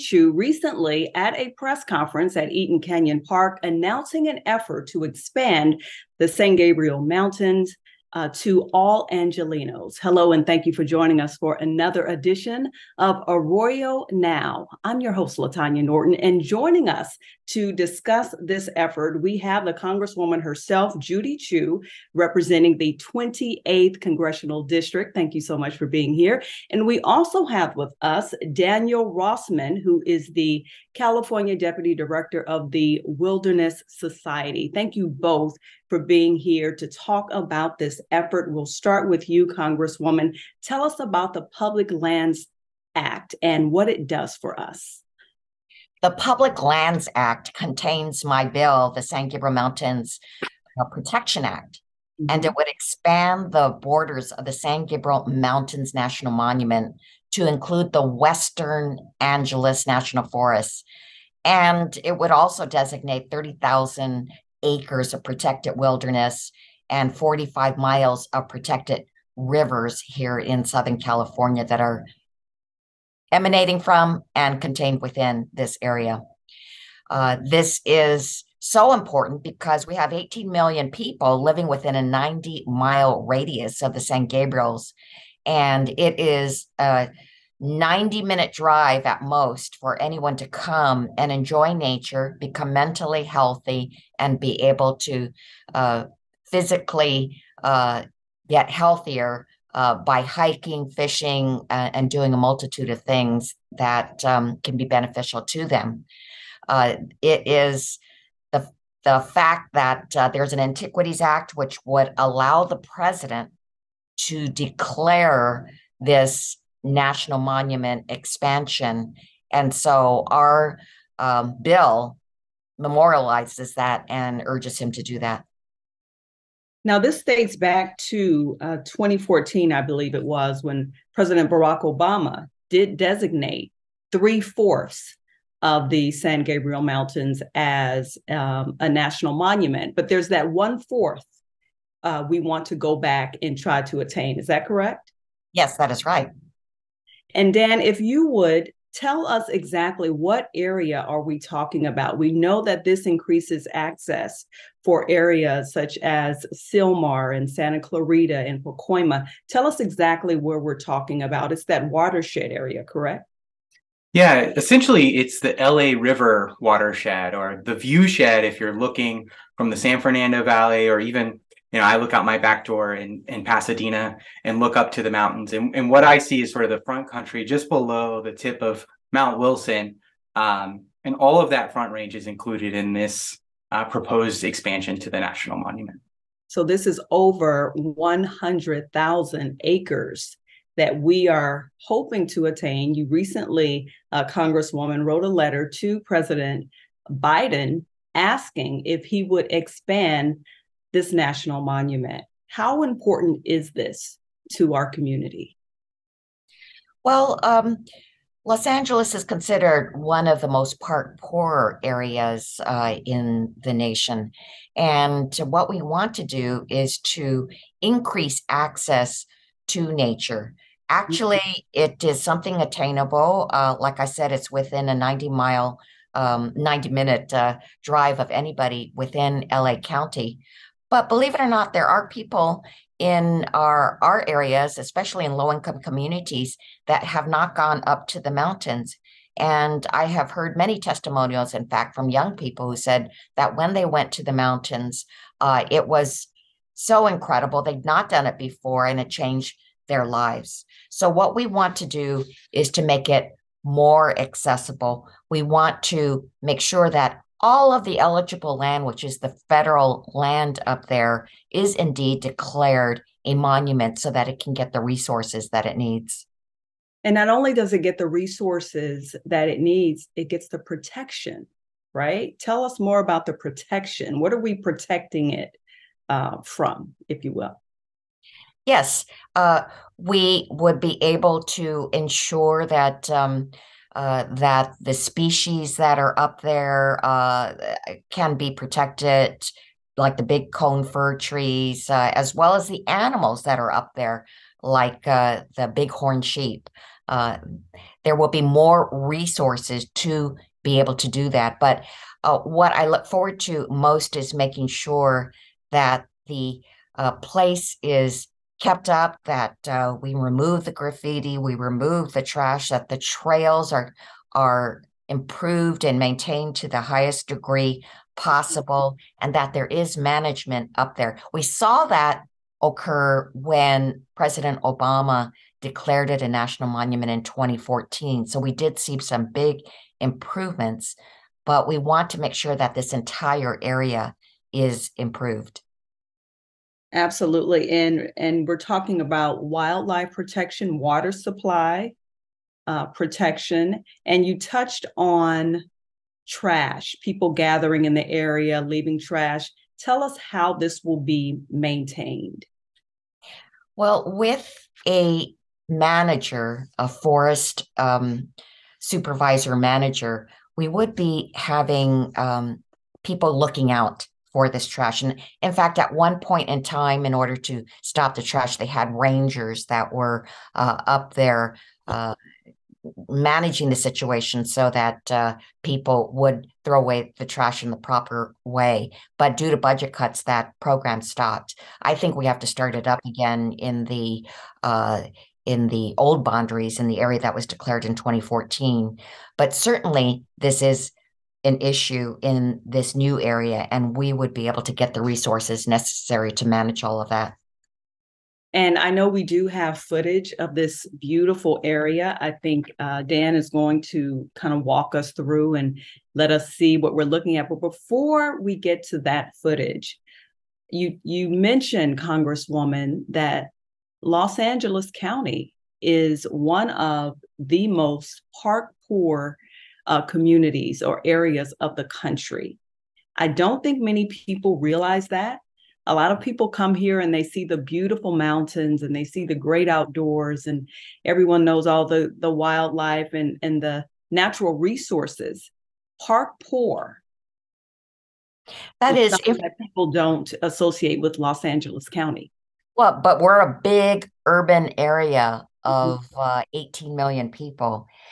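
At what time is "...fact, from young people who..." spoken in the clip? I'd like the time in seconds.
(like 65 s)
241 s.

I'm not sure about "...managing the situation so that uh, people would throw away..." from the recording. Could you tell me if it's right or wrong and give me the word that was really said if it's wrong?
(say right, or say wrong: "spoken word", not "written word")
right.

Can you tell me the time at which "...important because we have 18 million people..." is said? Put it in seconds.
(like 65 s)
78 s.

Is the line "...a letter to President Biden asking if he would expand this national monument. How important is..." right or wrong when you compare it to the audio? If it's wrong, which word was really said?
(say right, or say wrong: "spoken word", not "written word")
right.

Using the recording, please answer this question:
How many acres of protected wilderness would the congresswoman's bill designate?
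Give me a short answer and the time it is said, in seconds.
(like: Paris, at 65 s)
30,000, at 63 s.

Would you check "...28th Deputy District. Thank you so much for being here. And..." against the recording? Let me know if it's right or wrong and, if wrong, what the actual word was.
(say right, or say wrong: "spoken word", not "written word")
wrong: "Congressional", not "Deputy".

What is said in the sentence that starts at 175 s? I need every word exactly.
And, and what I see is sort of the front country just below the tip of Mount Wilson.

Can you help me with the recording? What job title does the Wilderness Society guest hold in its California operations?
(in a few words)
Deputy Director.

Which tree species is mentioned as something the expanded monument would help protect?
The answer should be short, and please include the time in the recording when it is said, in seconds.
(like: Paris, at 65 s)
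Big cone fir, at 290 s.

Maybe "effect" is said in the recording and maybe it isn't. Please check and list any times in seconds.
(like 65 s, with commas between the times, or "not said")
not said.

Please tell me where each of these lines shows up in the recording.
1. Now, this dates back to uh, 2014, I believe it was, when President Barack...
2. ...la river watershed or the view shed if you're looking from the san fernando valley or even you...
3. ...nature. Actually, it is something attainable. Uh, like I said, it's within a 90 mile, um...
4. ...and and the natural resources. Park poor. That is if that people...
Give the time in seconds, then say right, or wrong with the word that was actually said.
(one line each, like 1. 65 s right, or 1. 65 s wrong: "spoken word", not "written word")
1. 126 s right
2. 165 s right
3. 219 s right
4. 433 s right.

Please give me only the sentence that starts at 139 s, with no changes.
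But there's that one fourth uh, we want to go back and try to attain.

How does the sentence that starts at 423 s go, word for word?
I don't think many people realize that.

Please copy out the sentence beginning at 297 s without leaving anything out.
Uh, there will be more resources to be able to do that.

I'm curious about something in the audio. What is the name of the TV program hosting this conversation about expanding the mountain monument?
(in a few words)
Arroyo Now.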